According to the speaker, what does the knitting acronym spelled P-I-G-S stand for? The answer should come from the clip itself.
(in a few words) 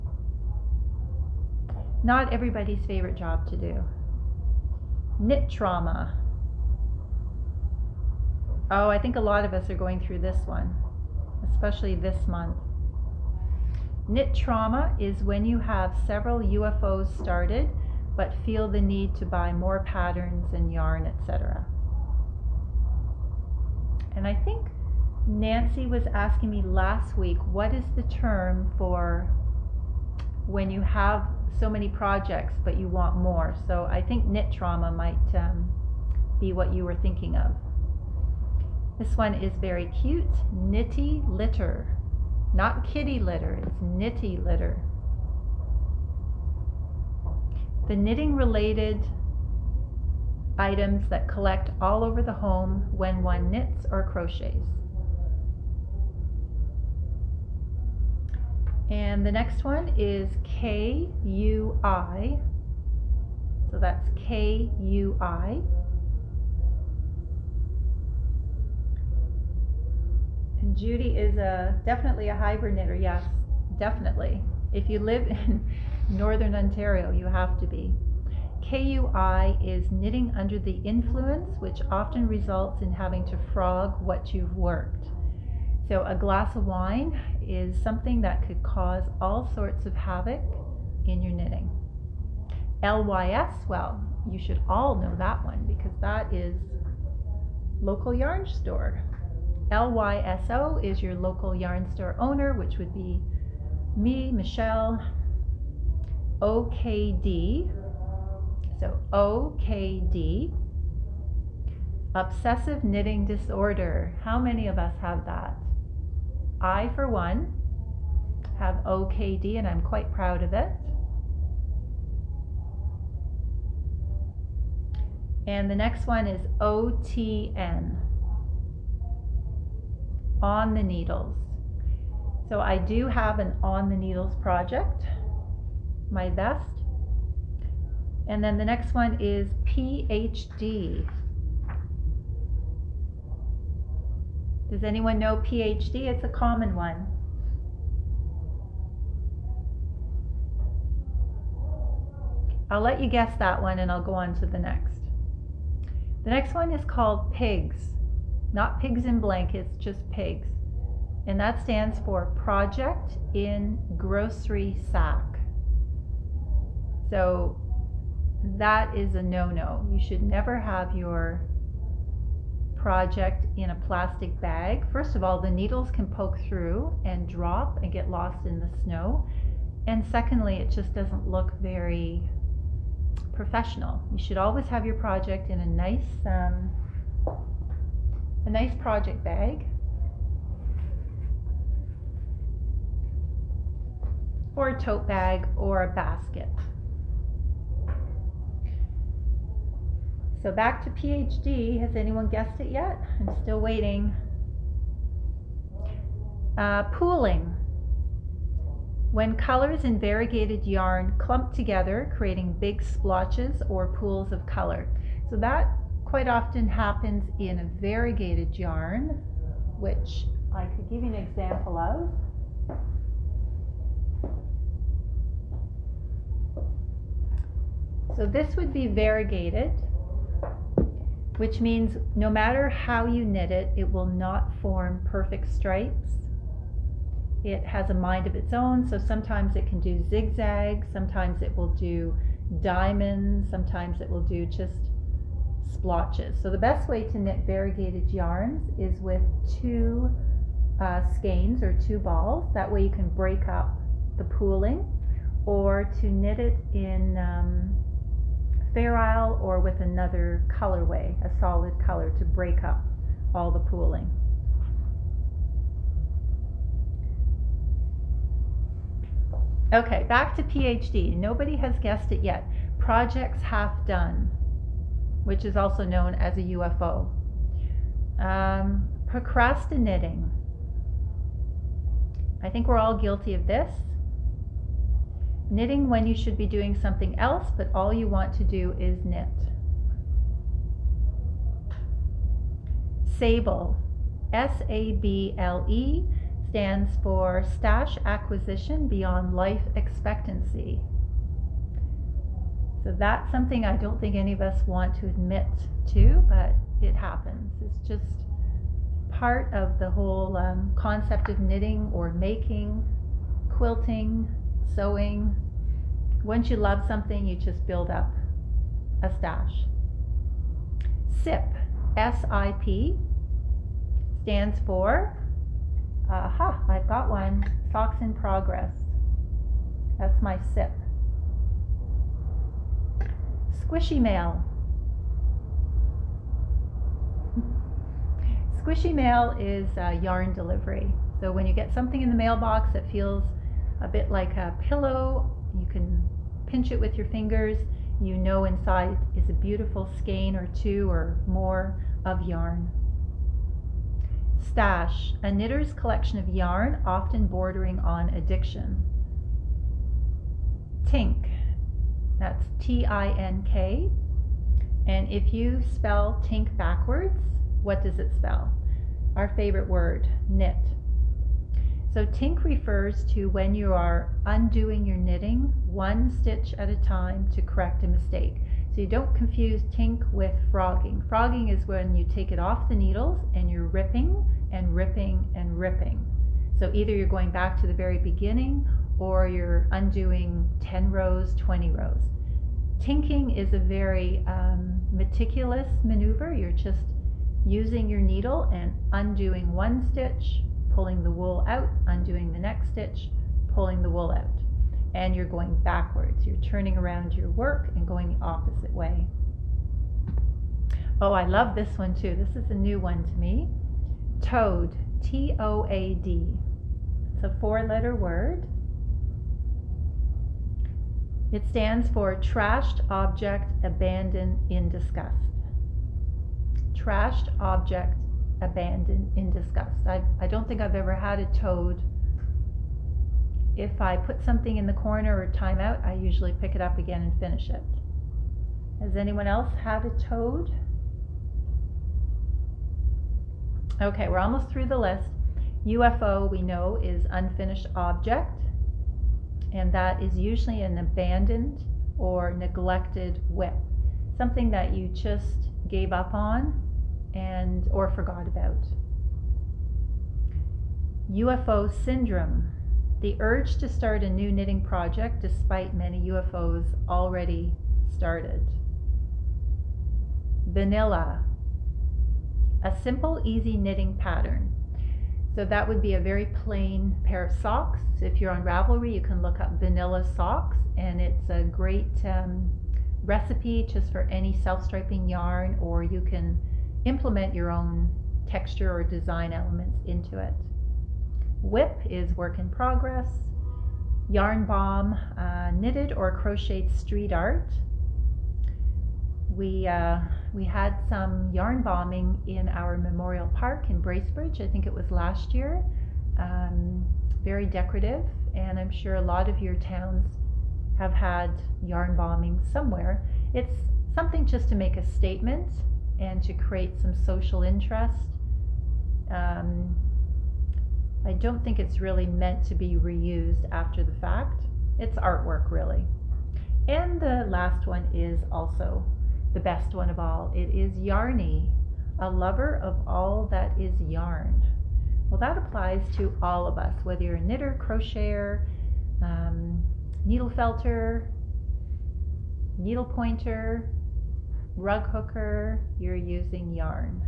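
Project in Grocery Sack.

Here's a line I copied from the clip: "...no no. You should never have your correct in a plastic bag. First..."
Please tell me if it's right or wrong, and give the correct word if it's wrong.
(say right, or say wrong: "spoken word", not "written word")
wrong: "project", not "correct".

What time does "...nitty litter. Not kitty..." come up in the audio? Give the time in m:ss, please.
0:40.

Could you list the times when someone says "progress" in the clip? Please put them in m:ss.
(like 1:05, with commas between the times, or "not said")
5:28, 8:12.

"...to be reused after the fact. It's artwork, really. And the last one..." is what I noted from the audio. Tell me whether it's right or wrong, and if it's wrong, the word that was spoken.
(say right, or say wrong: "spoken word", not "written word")
right.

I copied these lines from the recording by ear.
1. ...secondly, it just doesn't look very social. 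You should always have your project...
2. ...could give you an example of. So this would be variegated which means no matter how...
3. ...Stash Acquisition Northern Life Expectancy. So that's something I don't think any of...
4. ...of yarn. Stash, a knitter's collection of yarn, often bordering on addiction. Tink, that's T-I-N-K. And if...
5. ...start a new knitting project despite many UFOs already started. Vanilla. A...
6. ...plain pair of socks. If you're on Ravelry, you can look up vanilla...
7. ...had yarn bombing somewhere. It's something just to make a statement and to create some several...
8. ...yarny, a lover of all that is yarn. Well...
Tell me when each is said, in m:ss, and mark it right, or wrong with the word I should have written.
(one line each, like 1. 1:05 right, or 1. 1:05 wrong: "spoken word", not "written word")
1. 3:00 wrong: "professional", not "social"
2. 3:40 right
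3. 4:57 wrong: "Beyond", not "Northern"
4. 5:52 right
5. 7:43 right
6. 7:56 right
7. 8:30 wrong: "social", not "several"
8. 8:50 right.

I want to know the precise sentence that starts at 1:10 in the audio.
And Judy is a definitely a hybrid knitter.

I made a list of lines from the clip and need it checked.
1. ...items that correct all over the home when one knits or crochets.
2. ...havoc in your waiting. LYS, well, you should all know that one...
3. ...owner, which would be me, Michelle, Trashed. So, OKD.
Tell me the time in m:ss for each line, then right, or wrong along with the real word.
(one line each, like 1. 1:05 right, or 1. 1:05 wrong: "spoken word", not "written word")
1. 0:50 wrong: "collect", not "correct"
2. 1:29 wrong: "knitting", not "waiting"
3. 1:42 wrong: "OKD", not "Trashed".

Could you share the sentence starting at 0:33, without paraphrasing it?
So I think knit trauma might um, be what you were thinking of.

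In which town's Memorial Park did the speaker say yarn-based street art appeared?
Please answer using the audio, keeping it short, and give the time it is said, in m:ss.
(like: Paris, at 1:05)
Bracebridge, at 8:23.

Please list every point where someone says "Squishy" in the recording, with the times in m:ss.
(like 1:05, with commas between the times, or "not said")
5:33, 5:38.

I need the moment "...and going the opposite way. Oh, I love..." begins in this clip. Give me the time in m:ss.
6:47.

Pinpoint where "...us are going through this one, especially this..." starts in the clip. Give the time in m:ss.
0:09.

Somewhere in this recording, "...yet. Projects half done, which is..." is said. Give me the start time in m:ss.
4:32.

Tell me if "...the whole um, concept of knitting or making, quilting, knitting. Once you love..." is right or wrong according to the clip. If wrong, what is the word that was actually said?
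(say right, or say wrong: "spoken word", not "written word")
wrong: "sewing", not "knitting".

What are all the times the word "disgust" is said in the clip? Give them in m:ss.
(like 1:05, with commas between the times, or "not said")
7:04, 7:09.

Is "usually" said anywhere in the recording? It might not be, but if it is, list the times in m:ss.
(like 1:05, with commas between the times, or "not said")
7:15, 7:30.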